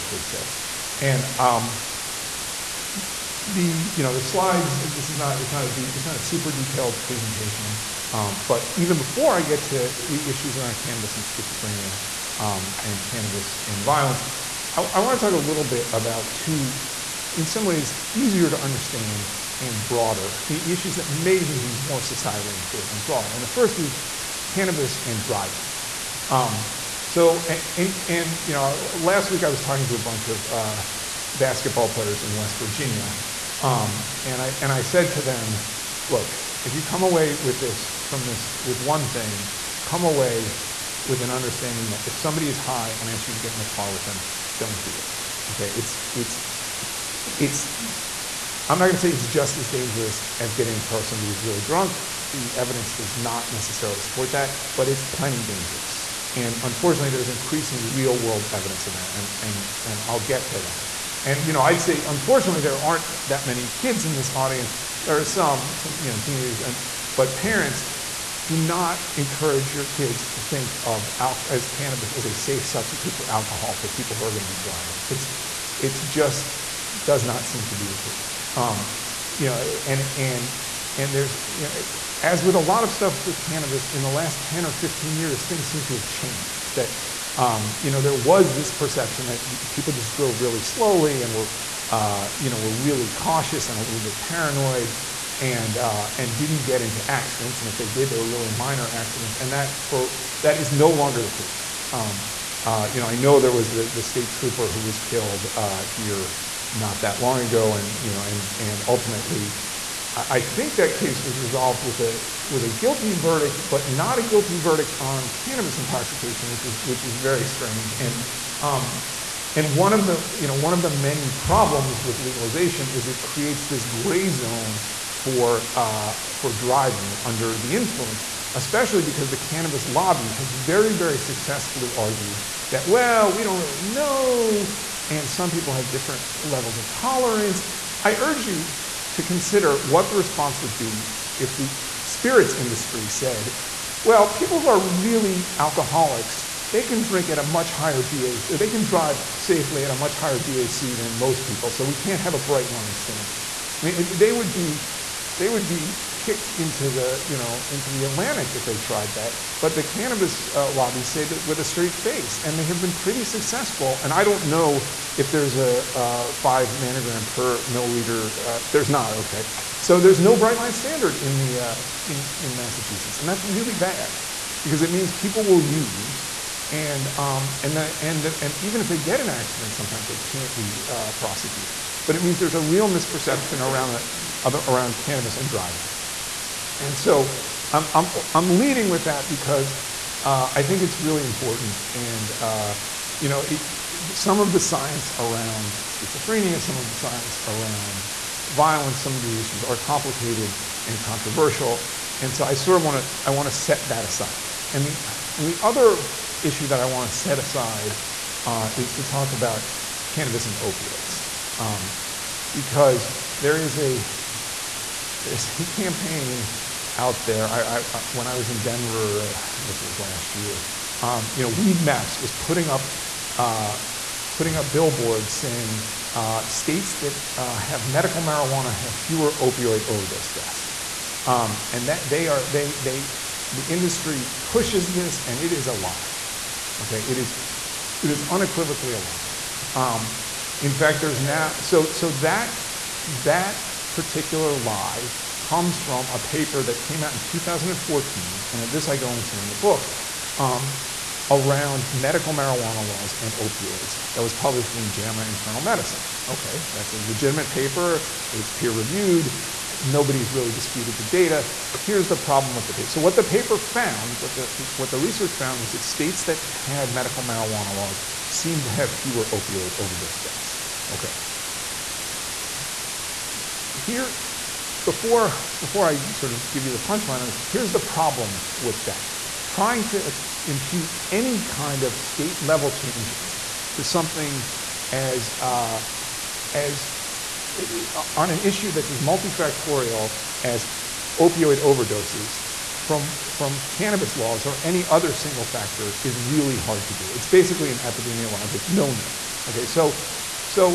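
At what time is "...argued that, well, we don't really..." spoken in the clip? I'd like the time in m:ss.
2:11.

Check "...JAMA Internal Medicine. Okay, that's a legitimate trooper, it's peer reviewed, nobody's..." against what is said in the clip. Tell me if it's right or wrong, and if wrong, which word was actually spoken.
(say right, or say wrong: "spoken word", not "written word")
wrong: "paper", not "trooper".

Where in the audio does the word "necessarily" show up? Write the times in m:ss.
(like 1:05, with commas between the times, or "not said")
0:53.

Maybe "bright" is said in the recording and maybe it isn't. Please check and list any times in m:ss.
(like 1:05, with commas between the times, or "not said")
2:32, 2:50.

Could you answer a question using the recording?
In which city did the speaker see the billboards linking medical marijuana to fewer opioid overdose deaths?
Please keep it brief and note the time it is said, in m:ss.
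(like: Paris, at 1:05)
Denver, at 3:38.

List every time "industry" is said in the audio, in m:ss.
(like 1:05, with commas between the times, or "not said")
2:22, 3:53.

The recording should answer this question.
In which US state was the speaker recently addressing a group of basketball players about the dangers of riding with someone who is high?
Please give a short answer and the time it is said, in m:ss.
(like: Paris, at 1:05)
West Virginia, at 0:32.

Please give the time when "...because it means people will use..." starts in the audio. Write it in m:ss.
2:54.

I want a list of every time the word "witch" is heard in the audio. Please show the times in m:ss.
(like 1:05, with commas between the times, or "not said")
not said.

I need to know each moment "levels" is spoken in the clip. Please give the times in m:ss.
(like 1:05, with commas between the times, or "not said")
2:16, 4:42.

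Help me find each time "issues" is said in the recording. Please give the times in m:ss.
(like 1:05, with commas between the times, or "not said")
0:10, 0:20, 3:19, 3:26, 4:48.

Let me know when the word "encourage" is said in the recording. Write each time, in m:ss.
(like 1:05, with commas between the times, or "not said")
1:09.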